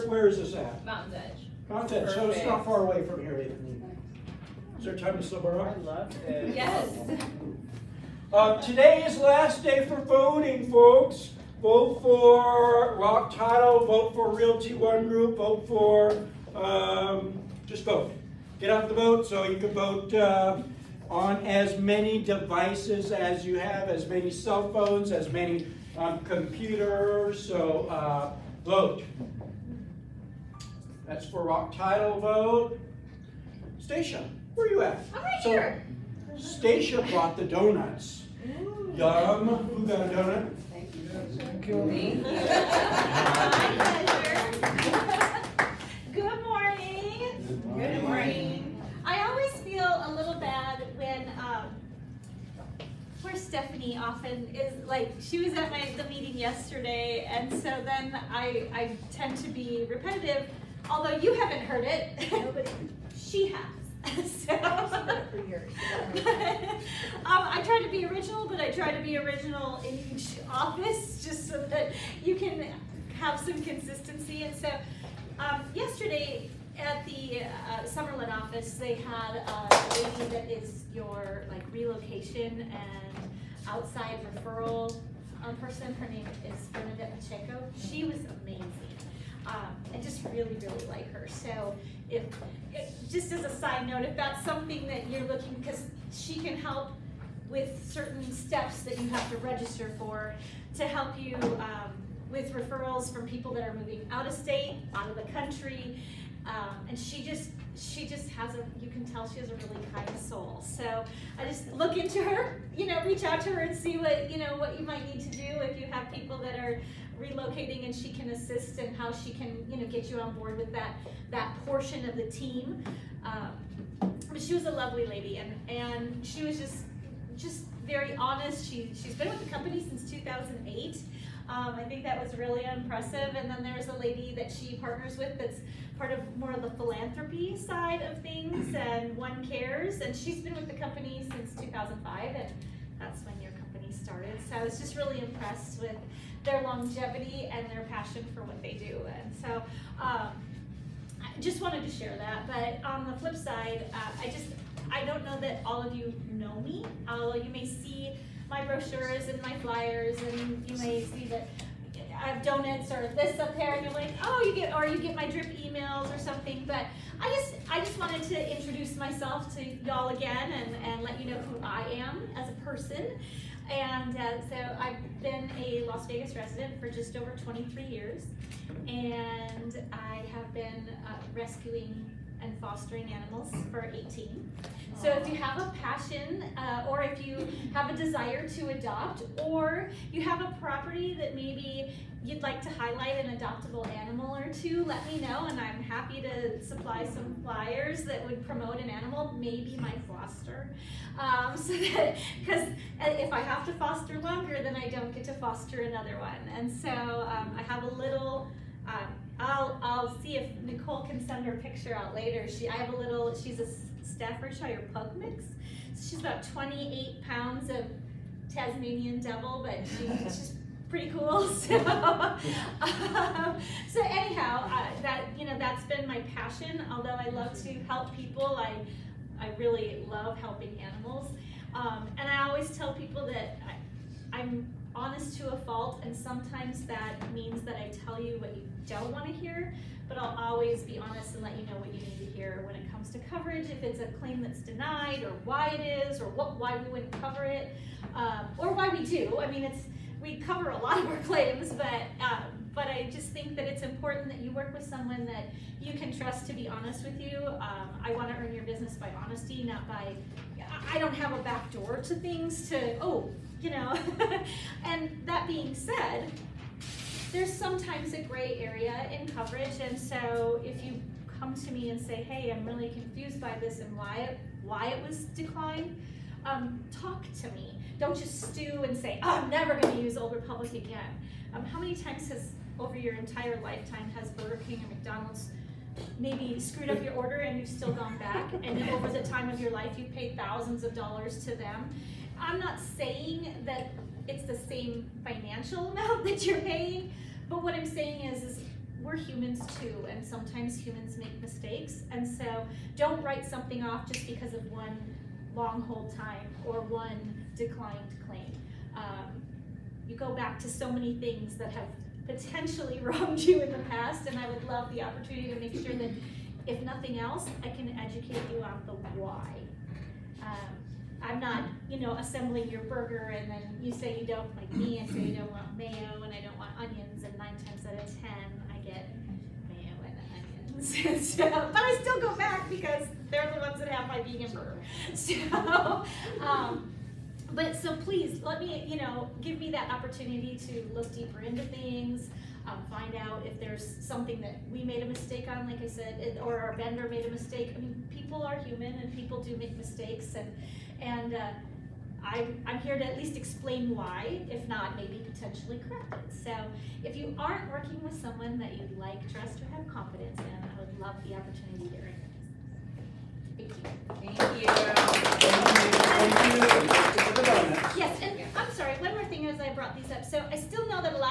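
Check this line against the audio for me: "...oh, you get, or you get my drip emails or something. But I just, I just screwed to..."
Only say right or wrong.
wrong.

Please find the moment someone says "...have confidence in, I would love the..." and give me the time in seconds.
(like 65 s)
359 s.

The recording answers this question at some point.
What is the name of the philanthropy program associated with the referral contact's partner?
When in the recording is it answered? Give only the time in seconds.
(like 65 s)
139 s.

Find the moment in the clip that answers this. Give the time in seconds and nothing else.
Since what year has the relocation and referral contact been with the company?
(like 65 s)
130 s.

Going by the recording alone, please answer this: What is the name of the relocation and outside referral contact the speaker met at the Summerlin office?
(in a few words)
Bernadette Pacheco.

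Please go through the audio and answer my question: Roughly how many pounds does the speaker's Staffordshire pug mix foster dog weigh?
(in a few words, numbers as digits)
28.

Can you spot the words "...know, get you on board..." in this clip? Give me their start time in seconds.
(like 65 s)
119 s.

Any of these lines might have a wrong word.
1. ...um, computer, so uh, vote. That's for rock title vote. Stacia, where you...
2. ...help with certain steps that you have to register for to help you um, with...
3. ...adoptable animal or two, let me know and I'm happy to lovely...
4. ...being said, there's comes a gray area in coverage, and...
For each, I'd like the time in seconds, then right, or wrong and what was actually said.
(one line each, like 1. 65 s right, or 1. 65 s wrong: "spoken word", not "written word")
1. 25 s right
2. 96 s right
3. 193 s wrong: "supply", not "lovely"
4. 265 s wrong: "sometimes", not "comes".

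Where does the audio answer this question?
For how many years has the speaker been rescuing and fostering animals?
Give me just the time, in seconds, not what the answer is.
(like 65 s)
183 s.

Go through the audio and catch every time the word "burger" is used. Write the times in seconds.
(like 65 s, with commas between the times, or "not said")
284 s, 322 s, 334 s.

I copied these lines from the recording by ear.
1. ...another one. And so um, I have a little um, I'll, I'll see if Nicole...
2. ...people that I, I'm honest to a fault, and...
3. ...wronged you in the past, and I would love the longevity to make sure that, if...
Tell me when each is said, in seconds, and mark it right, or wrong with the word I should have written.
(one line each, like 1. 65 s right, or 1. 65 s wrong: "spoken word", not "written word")
1. 205 s right
2. 232 s right
3. 313 s wrong: "opportunity", not "longevity".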